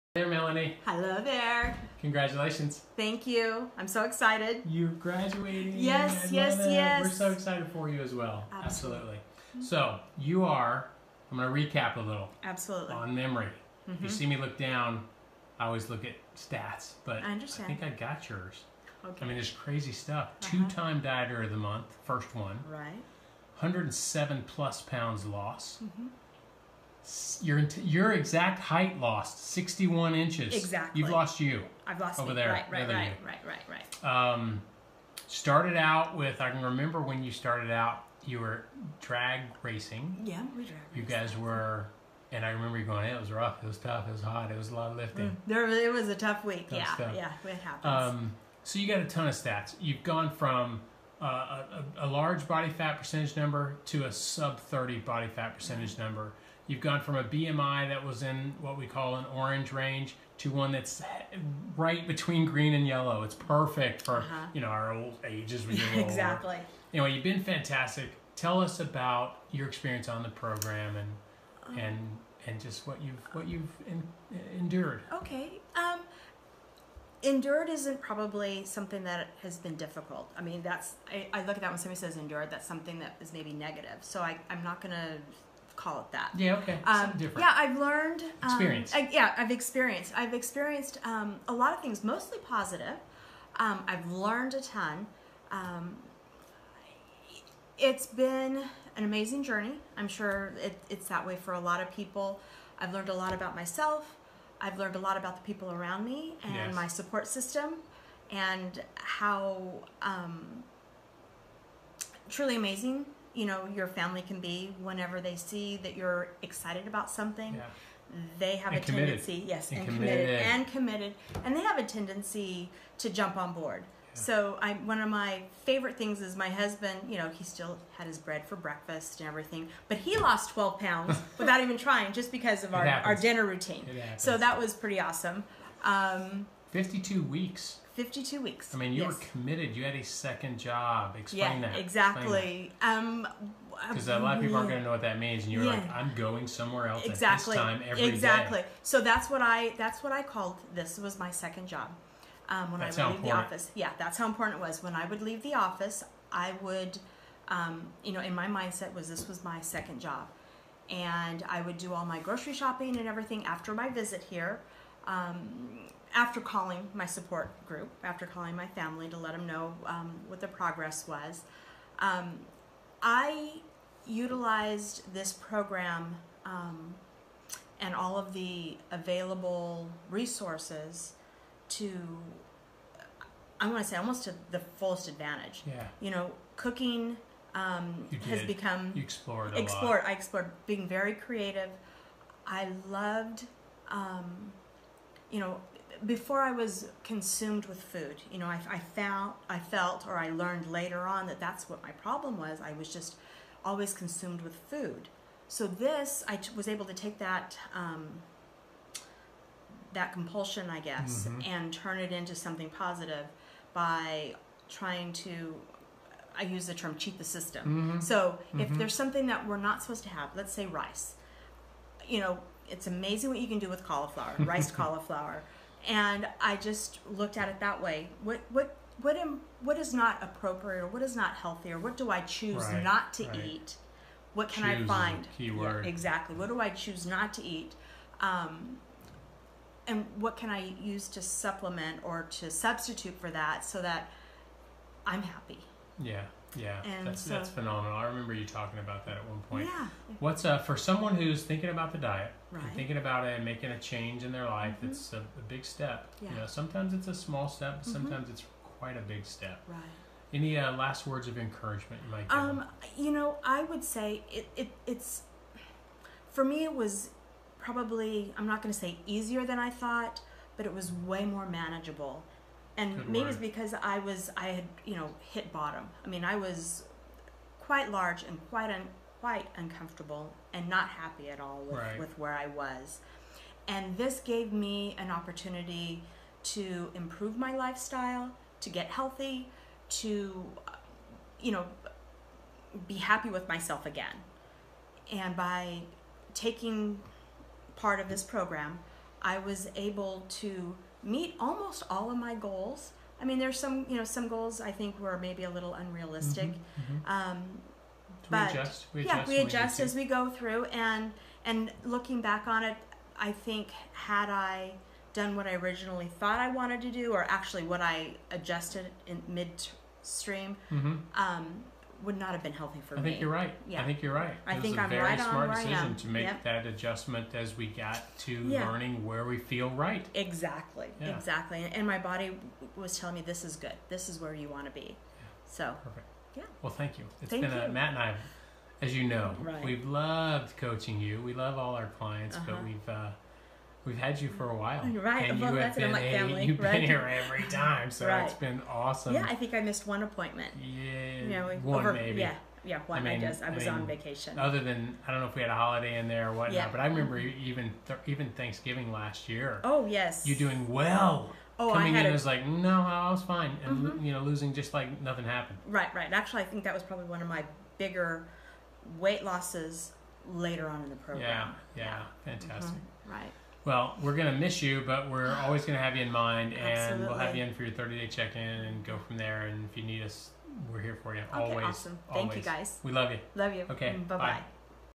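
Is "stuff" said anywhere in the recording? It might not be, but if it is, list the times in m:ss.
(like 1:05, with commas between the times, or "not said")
0:19, 0:46.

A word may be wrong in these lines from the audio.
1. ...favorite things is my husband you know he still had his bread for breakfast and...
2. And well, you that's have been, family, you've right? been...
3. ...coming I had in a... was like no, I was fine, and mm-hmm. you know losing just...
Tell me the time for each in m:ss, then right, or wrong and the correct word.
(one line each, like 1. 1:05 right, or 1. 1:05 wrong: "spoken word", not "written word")
1. 2:05 right
2. 5:45 right
3. 6:01 right.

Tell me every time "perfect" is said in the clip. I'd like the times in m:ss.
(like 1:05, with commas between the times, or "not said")
1:03, 5:35.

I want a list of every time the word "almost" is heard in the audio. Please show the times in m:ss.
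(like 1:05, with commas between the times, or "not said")
3:03, 5:01.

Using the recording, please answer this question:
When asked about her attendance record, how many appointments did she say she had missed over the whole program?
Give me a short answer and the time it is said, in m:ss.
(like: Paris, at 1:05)
1, at 5:49.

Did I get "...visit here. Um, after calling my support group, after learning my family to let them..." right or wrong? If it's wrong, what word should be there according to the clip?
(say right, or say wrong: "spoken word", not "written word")
wrong: "calling", not "learning".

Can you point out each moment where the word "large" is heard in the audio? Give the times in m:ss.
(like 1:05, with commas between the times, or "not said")
0:52, 4:37.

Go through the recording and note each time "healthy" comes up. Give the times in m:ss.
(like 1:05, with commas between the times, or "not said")
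3:51, 4:48, 5:22.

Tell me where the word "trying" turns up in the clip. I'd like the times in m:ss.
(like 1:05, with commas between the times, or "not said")
2:11, 3:34.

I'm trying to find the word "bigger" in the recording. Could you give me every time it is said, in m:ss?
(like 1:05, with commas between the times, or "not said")
6:07.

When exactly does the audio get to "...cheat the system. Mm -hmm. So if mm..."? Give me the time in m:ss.
3:36.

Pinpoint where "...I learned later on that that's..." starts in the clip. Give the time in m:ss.
3:20.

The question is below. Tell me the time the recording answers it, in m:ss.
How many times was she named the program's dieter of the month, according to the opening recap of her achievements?
0:20.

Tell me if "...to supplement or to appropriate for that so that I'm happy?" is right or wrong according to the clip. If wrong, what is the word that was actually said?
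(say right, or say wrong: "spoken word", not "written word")
wrong: "substitute", not "appropriate".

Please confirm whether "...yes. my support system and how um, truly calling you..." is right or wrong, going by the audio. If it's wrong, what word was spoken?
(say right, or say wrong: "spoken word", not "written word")
wrong: "amazing", not "calling".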